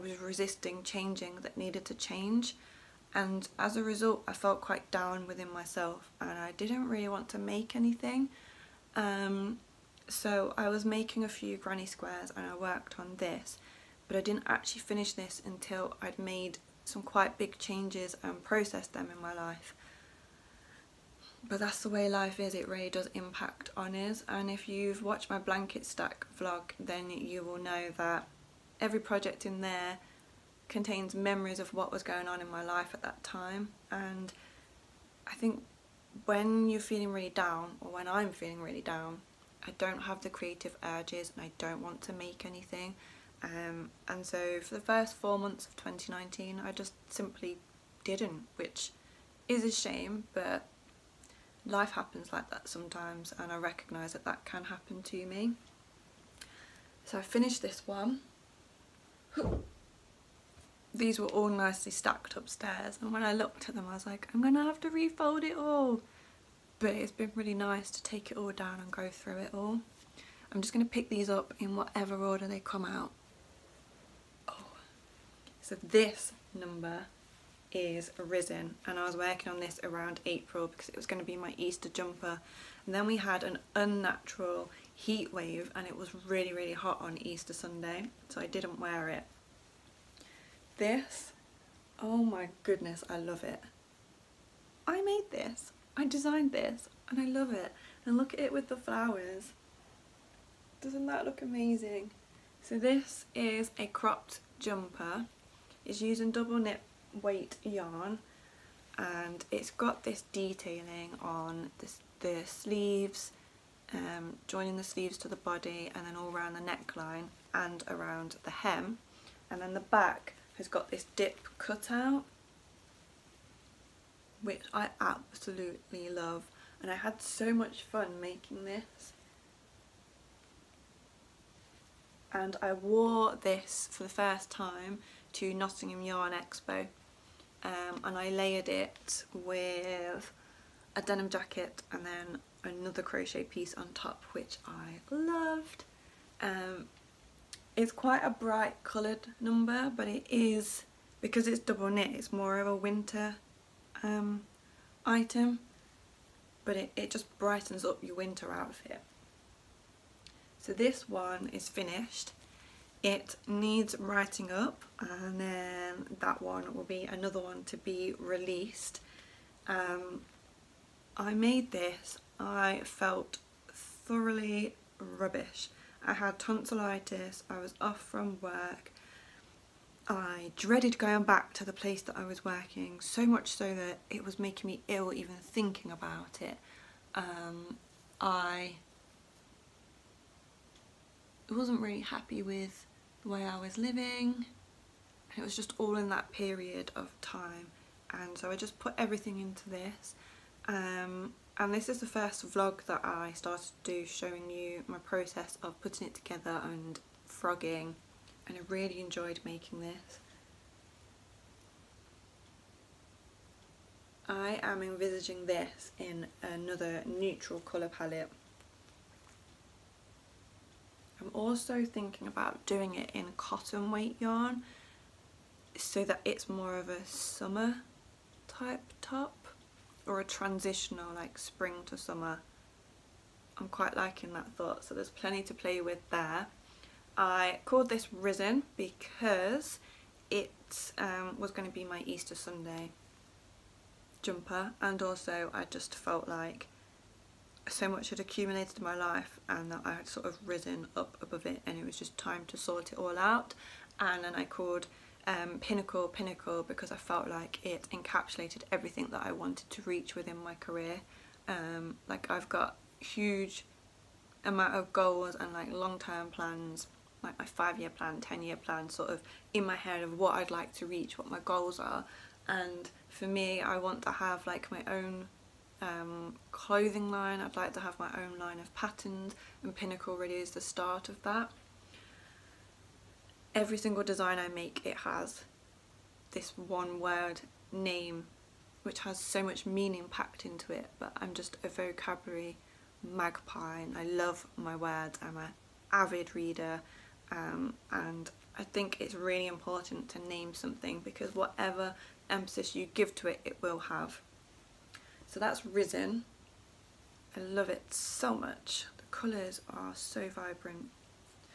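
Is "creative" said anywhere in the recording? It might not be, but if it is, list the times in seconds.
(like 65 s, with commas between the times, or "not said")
40 s.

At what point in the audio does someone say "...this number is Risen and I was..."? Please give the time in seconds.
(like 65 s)
75 s.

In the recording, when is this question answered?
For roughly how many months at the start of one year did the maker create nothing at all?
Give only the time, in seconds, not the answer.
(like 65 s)
45 s.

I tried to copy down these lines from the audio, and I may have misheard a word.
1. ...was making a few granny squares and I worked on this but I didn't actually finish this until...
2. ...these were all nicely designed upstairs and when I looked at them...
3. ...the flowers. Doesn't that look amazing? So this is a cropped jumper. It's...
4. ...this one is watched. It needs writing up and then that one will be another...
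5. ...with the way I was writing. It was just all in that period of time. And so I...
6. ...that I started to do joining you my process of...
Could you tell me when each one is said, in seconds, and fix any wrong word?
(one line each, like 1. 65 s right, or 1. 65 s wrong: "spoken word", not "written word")
1. 10 s right
2. 60 s wrong: "stacked", not "designed"
3. 98 s right
4. 160 s wrong: "finished", not "watched"
5. 192 s wrong: "living", not "writing"
6. 202 s wrong: "showing", not "joining".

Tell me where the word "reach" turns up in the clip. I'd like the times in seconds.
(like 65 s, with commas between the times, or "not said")
259 s, 270 s.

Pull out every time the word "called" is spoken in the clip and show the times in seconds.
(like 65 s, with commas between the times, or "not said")
237 s, 254 s.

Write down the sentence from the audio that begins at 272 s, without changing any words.
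And for me, I want to have like my own um, clothing line.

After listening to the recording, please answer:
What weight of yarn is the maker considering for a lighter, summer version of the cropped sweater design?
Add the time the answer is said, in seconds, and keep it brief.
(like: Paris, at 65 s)
cotton weight, at 223 s.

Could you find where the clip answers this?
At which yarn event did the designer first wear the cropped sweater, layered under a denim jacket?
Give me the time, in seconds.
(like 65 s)
135 s.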